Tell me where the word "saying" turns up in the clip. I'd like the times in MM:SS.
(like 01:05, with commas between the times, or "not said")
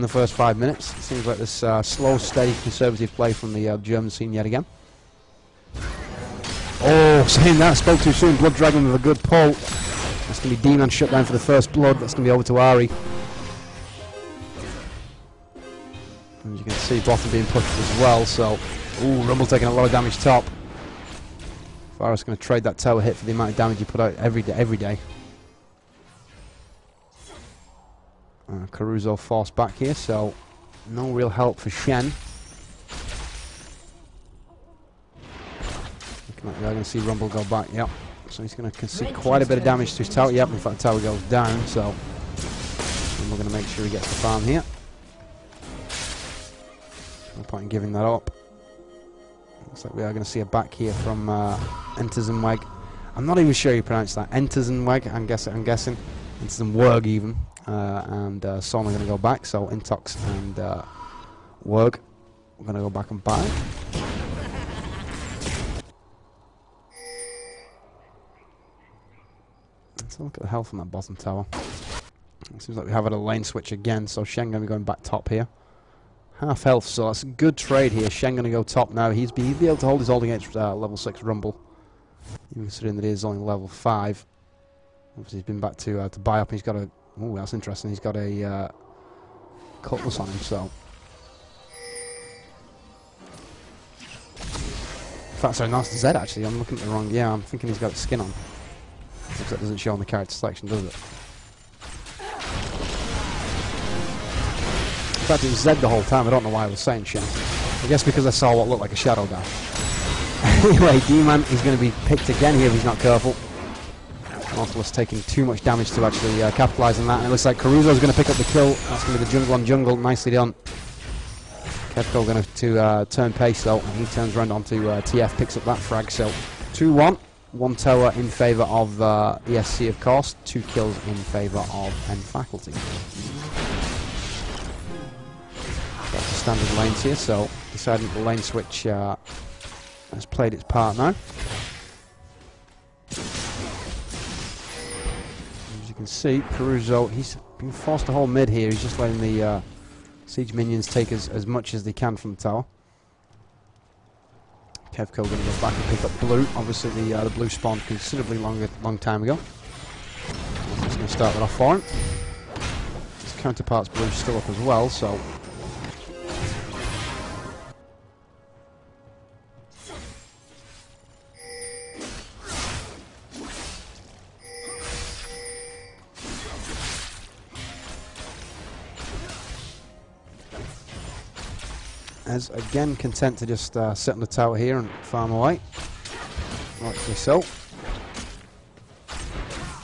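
00:07, 01:46.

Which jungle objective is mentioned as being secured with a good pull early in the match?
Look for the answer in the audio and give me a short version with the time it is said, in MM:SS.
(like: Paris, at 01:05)
Blood Dragon, at 00:08.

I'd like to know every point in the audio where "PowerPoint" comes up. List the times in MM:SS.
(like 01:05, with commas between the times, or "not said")
not said.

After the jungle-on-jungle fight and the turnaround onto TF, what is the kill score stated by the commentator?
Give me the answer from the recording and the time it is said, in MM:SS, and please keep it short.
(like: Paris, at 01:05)
2-1, at 02:06.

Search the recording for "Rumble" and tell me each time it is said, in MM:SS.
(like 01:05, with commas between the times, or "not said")
00:19, 00:36, 00:43, 01:21.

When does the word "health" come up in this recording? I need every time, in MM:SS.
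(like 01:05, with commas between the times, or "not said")
01:10, 01:16.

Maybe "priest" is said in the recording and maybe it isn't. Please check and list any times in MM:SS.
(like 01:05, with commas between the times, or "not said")
not said.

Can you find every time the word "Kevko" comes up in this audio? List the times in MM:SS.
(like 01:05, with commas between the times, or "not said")
02:01.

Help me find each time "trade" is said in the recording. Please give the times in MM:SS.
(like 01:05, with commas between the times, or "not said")
00:22, 01:17.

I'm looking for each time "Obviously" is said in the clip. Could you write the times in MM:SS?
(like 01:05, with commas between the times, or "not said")
01:25, 02:36.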